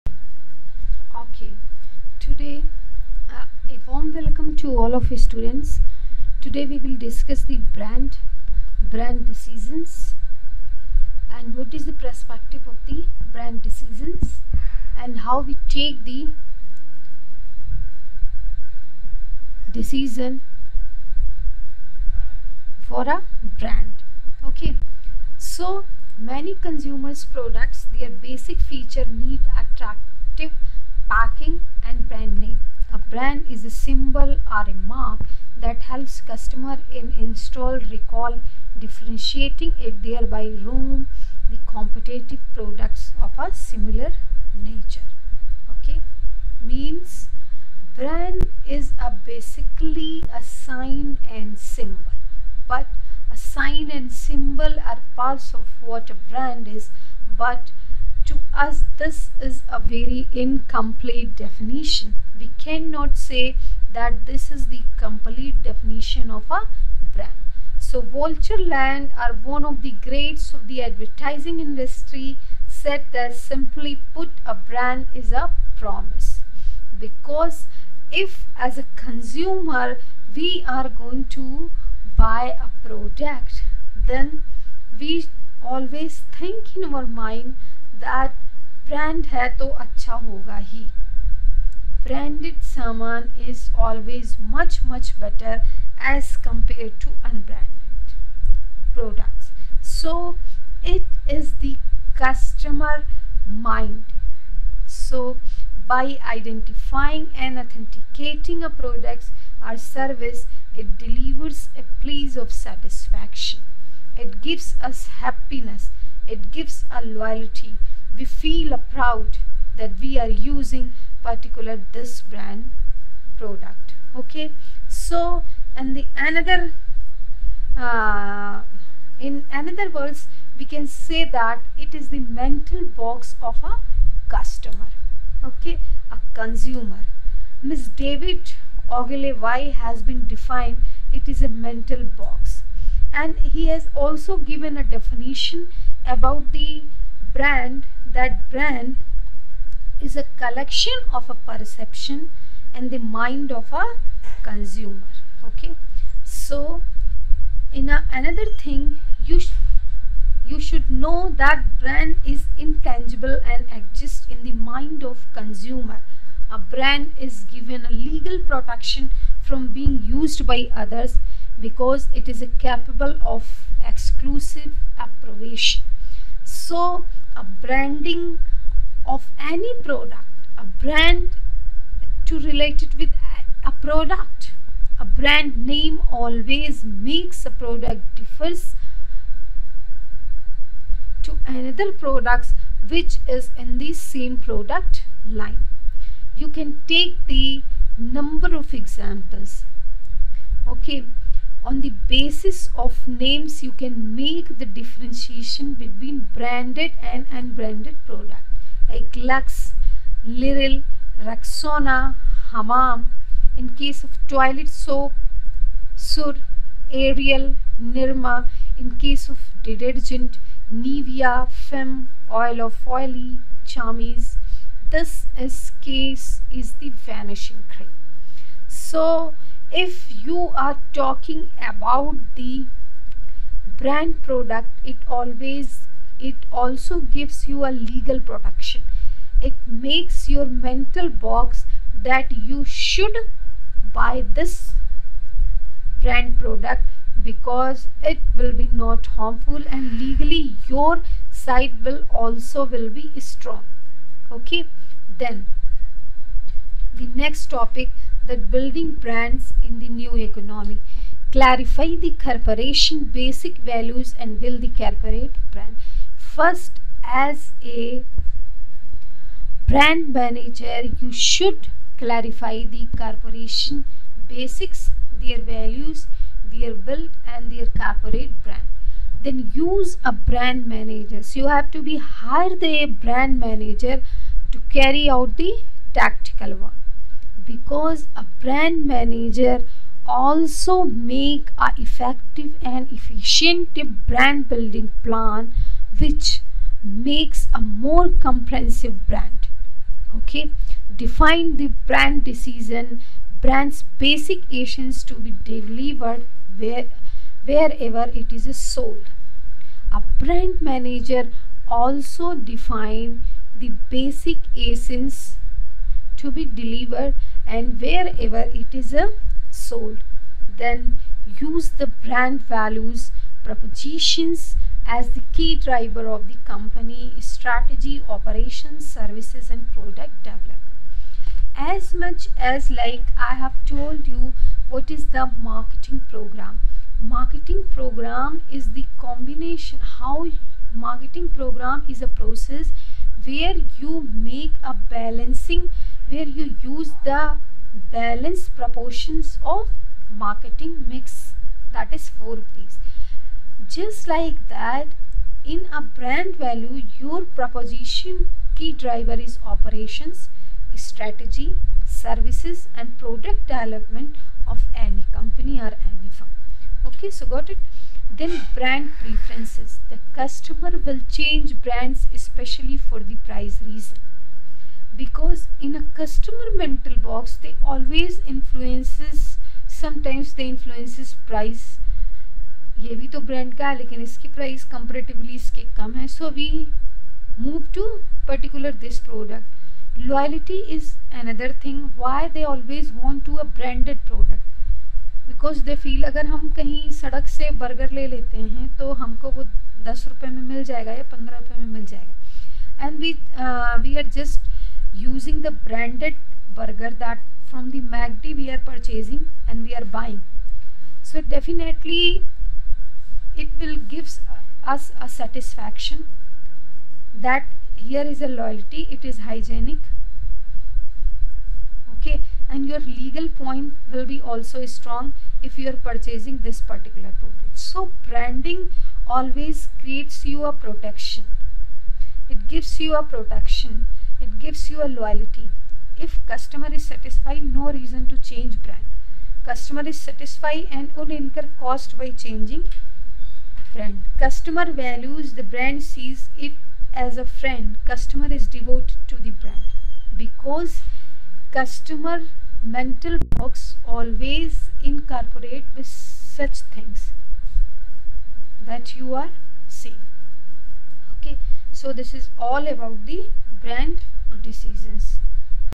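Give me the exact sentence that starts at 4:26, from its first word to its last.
First, as a brand manager, you should clarify the corporation basics, their values, their build, and their corporate brand.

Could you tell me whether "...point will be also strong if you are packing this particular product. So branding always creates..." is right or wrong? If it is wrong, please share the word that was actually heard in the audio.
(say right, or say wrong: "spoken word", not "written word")
wrong: "purchasing", not "packing".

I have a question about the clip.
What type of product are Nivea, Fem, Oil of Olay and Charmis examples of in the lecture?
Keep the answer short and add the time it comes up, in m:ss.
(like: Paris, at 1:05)
Vanishing cream, at 3:46.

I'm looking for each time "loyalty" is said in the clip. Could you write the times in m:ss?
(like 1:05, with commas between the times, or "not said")
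1:57, 6:58, 7:14.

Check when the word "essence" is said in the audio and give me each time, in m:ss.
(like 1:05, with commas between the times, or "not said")
5:04, 5:14.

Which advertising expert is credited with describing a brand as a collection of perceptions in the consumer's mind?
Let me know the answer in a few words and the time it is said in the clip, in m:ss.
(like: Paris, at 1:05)
David Ogilvy, at 2:18.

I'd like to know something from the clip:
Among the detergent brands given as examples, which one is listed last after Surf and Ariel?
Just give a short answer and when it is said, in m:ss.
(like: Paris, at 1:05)
Nirma, at 3:37.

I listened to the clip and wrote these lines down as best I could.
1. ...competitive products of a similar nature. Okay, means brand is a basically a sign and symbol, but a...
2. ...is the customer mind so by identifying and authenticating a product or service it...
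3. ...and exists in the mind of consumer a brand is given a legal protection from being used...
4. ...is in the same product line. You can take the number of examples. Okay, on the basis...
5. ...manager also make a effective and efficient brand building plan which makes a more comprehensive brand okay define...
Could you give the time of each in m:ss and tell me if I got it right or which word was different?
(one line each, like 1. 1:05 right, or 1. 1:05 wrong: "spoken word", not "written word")
1. 0:41 right
2. 1:41 right
3. 2:43 right
4. 3:13 right
5. 4:48 right.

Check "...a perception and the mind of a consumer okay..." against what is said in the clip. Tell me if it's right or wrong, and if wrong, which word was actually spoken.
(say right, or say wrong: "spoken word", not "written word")
right.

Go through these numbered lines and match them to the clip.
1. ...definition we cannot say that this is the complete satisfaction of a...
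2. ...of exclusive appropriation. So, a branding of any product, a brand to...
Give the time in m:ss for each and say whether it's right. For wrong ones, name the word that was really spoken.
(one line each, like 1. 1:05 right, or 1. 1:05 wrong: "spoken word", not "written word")
1. 1:01 wrong: "definition", not "satisfaction"
2. 2:53 right.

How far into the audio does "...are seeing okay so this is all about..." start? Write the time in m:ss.
7:39.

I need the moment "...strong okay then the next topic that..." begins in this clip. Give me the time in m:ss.
4:13.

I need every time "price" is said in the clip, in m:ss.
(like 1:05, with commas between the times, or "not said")
6:13, 6:21.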